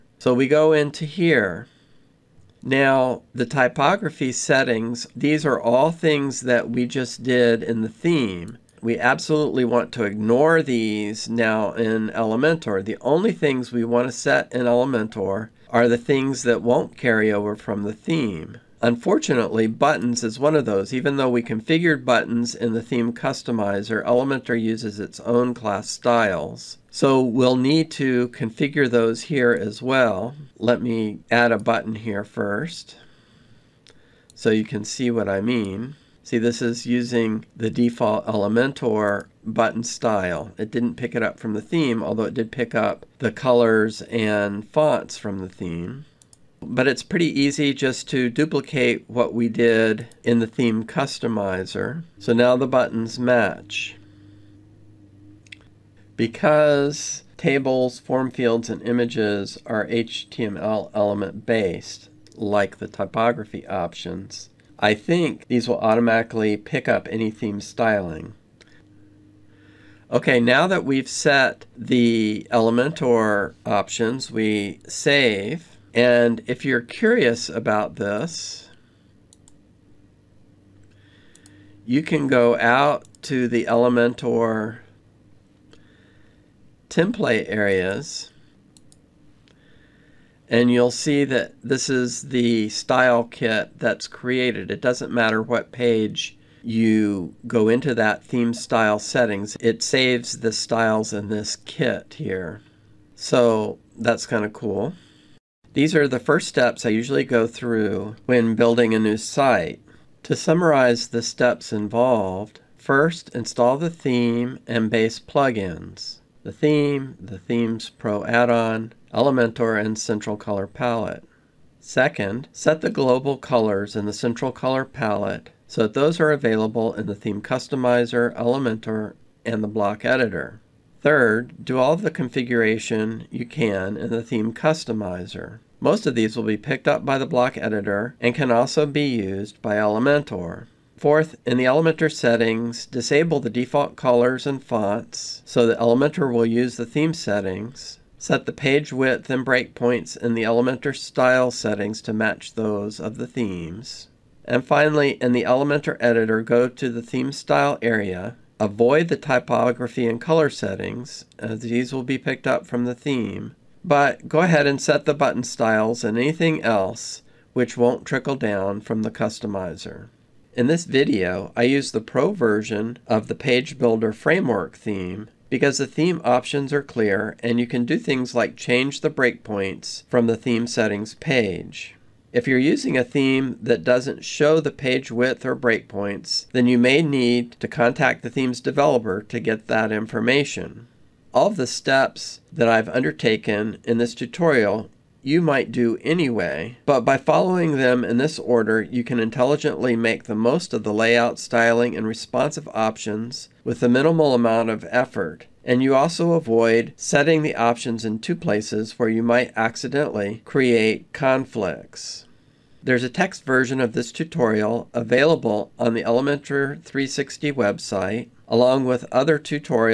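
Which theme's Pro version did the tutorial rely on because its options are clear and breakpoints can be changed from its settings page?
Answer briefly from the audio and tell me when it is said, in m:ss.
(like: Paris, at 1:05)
Page Builder Framework, at 2:53.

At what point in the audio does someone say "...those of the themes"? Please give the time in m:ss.
2:32.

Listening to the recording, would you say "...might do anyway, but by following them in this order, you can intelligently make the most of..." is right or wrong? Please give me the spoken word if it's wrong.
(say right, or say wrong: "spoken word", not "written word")
right.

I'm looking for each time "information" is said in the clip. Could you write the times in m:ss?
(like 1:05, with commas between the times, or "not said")
3:09.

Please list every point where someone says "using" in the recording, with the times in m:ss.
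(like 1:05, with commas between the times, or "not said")
0:36, 3:02.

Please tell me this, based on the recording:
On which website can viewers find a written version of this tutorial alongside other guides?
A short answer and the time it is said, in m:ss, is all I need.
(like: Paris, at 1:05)
Elementor 360, at 3:36.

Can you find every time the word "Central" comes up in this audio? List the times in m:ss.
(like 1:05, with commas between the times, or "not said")
1:59, 2:04.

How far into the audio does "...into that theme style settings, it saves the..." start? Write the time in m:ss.
1:37.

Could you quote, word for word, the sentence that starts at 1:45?
These are the first steps I usually go through when building a new site.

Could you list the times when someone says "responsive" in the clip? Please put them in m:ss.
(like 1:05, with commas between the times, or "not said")
3:22.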